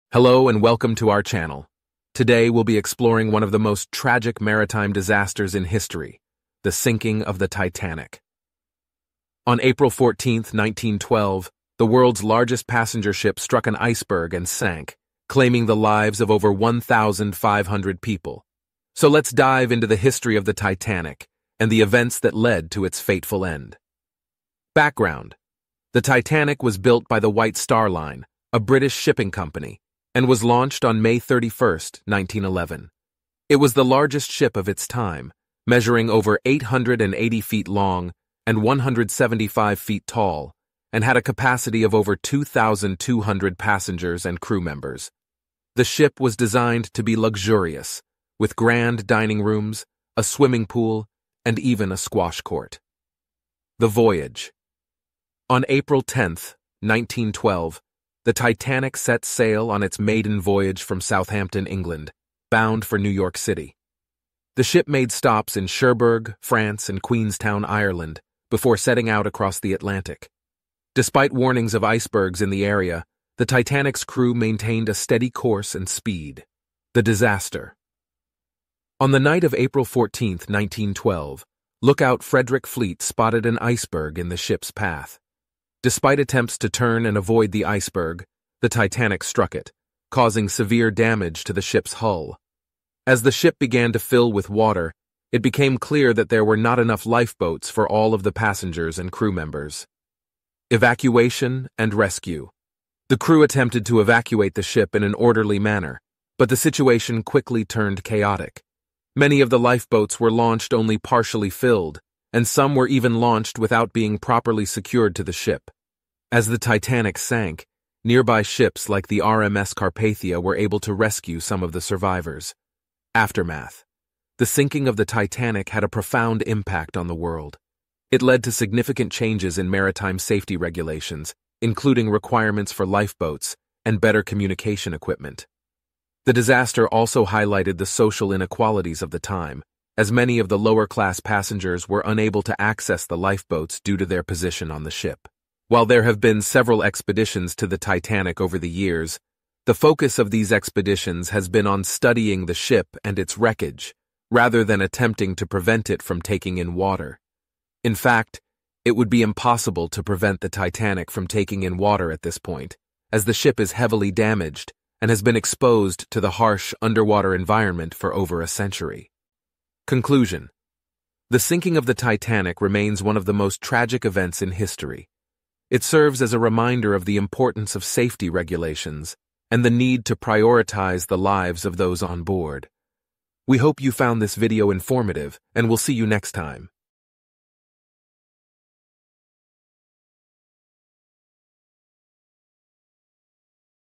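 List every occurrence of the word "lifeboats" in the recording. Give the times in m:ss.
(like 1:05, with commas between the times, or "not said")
1:37, 1:49, 2:12, 2:23.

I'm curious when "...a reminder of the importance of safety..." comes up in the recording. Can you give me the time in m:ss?
2:56.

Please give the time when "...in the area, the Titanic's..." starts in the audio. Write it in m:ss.
1:12.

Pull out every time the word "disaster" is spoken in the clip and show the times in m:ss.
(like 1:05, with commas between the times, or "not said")
0:04, 1:17, 2:16.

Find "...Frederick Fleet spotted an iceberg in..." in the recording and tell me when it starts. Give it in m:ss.
1:22.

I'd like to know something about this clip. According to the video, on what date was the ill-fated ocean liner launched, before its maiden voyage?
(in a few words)
May 31, 1911.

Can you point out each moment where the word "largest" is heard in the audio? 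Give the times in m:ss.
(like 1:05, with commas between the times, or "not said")
0:12, 0:33.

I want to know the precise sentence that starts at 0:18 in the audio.
So let's dive into the history of the Titanic and the events that led to its fateful end.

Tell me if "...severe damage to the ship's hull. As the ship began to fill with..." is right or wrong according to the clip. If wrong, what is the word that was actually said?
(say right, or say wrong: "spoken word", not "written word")
right.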